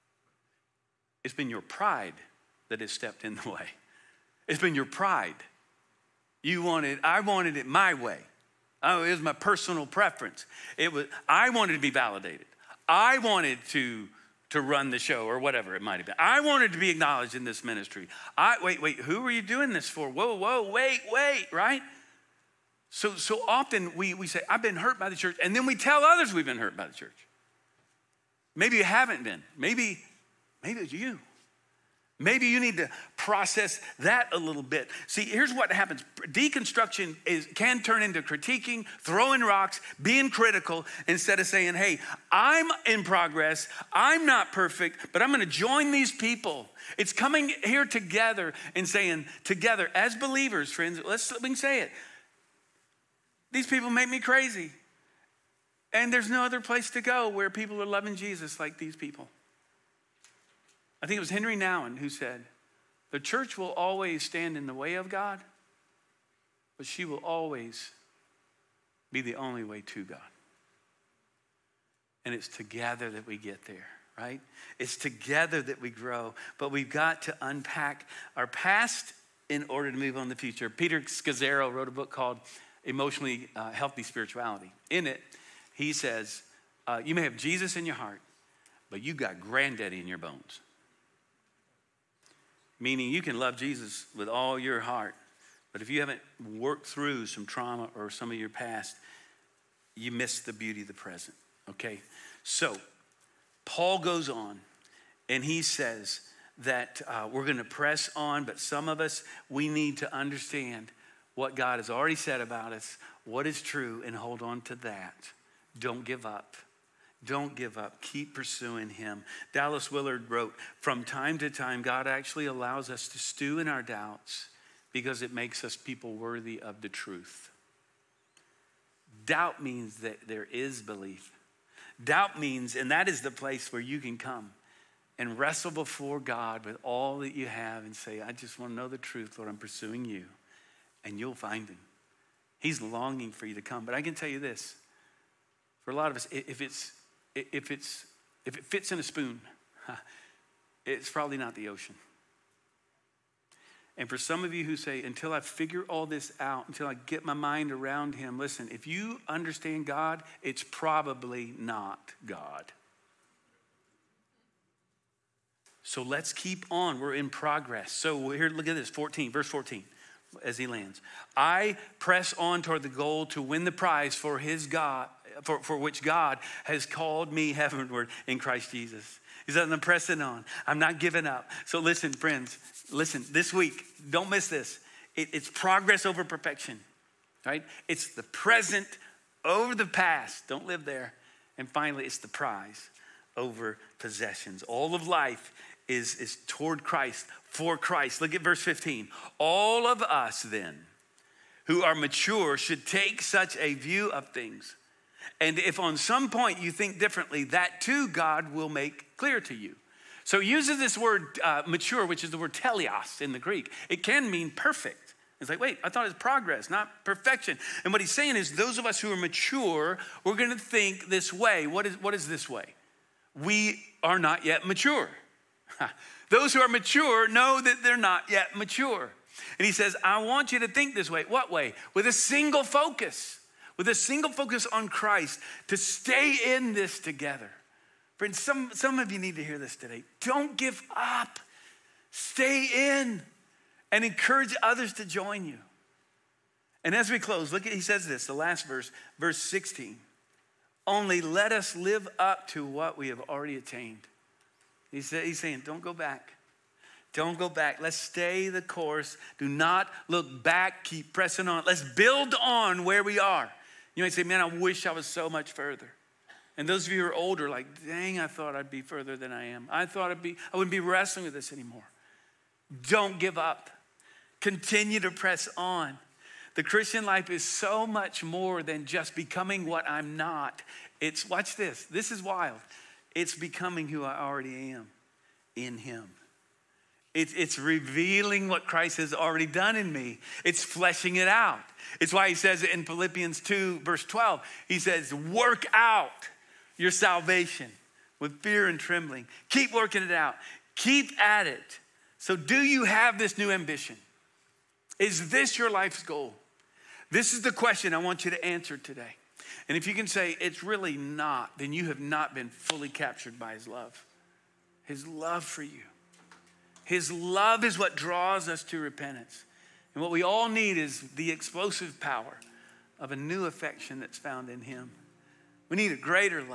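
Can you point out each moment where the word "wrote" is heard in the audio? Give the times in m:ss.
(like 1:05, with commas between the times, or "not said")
1:21, 2:00.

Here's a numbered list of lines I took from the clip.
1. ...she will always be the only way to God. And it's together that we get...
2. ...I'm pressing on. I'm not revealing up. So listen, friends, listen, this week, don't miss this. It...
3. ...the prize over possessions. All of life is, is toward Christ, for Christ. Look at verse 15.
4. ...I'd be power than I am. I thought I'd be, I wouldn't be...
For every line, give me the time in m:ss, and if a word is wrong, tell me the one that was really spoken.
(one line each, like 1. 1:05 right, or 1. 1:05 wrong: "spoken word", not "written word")
1. 1:06 right
2. 2:59 wrong: "giving", not "revealing"
3. 3:12 right
4. 4:28 wrong: "further", not "power".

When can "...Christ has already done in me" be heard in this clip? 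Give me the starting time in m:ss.
4:48.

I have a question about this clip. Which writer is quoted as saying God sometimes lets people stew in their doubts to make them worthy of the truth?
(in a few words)
Dallas Willard.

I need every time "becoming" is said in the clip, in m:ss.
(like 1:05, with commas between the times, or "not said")
4:39, 4:43.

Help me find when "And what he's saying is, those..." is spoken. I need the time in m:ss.
3:37.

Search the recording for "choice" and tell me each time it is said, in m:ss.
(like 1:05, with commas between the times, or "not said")
not said.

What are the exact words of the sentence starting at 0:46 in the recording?
It's coming here together and saying, together, as believers, friends, let's let me say it.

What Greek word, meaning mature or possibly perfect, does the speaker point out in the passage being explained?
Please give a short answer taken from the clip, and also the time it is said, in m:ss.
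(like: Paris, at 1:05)
teleos, at 3:32.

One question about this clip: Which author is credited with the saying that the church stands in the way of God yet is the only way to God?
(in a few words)
Henri Nouwen.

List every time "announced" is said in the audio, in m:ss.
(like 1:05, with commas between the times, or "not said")
not said.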